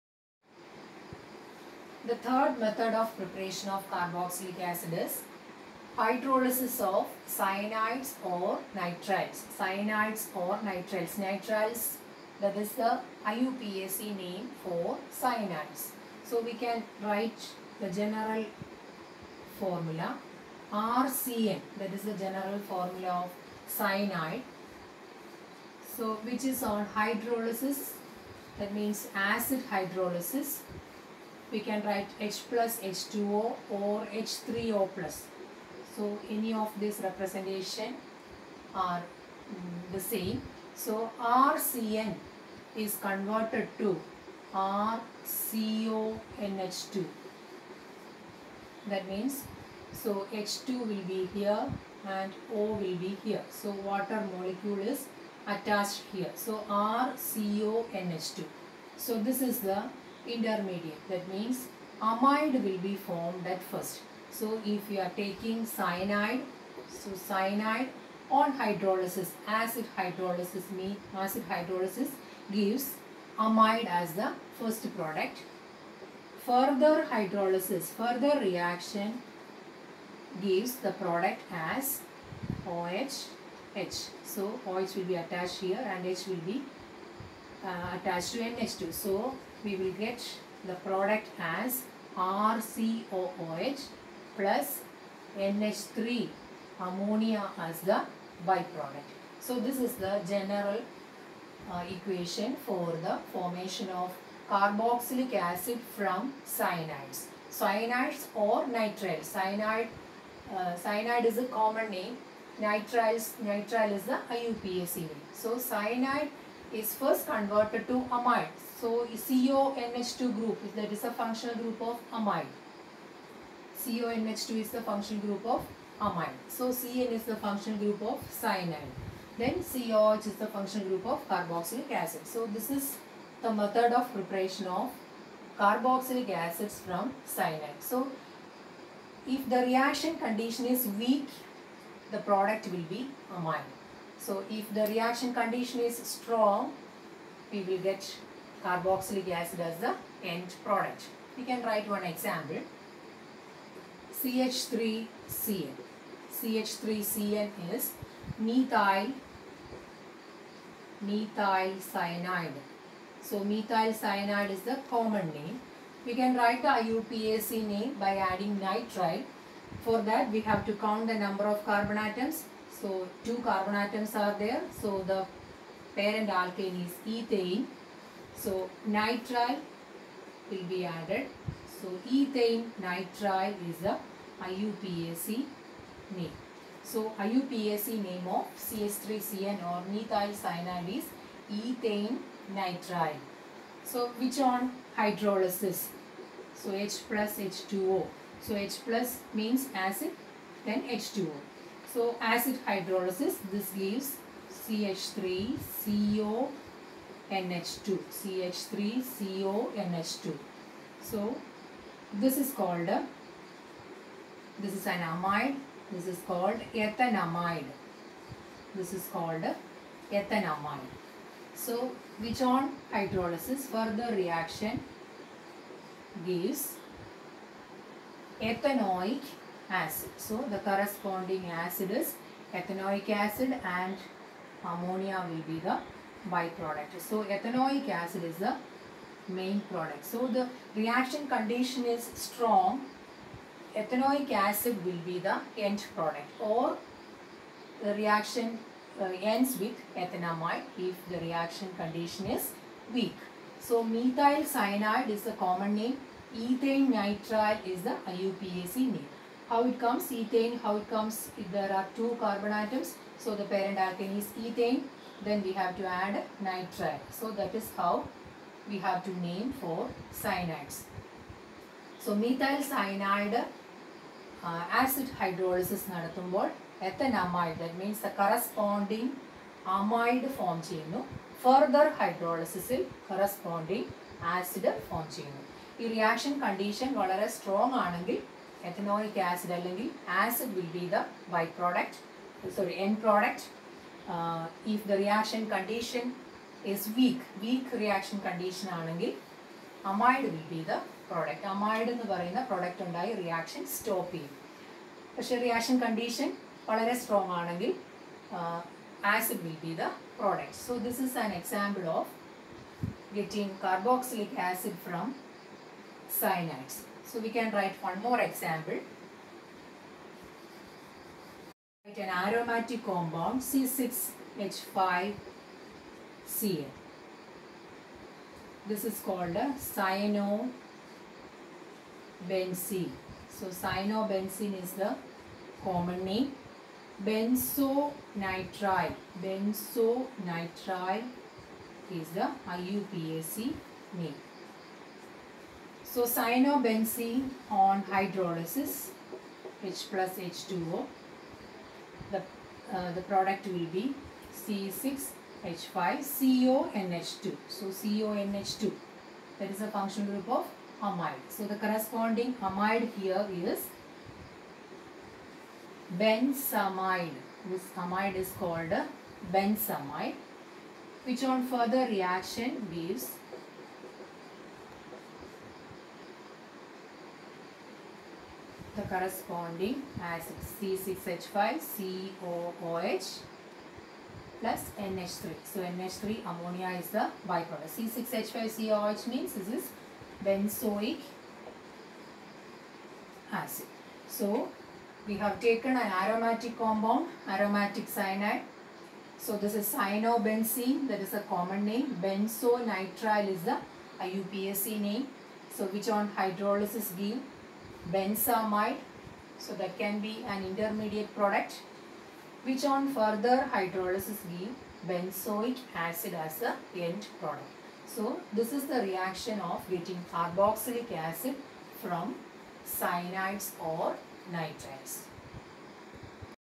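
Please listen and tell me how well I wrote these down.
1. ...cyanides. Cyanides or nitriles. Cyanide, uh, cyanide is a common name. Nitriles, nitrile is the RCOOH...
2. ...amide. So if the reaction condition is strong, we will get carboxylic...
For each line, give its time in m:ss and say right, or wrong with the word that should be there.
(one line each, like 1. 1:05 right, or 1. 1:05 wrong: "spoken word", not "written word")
1. 1:46 wrong: "IUPAC", not "RCOOH"
2. 2:23 right.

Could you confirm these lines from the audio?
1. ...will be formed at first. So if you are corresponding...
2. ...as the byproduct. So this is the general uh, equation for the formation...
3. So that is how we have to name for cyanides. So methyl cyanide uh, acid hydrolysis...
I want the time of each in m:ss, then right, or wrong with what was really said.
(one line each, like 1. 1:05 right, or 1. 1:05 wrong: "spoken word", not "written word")
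1. 1:02 wrong: "taking", not "corresponding"
2. 1:37 right
3. 4:27 right.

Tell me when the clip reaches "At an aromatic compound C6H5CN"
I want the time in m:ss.
5:21.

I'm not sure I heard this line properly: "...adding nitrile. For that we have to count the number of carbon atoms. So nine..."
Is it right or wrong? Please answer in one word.
wrong.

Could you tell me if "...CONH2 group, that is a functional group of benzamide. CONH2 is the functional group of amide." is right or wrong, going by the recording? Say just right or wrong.
wrong.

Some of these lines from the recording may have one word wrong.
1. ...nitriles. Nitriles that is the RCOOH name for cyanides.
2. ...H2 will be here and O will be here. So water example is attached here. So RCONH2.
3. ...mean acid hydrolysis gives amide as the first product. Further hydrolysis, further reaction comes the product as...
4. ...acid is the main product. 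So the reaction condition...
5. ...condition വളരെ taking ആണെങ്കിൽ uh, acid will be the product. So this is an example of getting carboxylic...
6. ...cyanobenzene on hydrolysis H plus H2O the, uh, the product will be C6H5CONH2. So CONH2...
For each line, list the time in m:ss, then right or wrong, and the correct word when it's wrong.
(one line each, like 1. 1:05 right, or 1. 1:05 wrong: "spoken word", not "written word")
1. 0:10 wrong: "IUPAC", not "RCOOH"
2. 0:50 wrong: "molecule", not "example"
3. 1:10 wrong: "gives", not "comes"
4. 3:57 right
5. 5:05 wrong: "strong", not "taking"
6. 5:46 right.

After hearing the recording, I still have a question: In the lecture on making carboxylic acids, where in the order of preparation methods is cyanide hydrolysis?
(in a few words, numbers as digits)
third.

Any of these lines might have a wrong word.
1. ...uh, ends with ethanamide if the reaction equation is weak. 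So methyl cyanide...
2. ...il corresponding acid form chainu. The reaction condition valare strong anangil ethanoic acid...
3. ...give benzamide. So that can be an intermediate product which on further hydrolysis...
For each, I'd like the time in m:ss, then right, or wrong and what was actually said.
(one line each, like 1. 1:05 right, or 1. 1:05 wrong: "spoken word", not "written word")
1. 4:08 wrong: "condition", not "equation"
2. 4:42 right
3. 6:46 right.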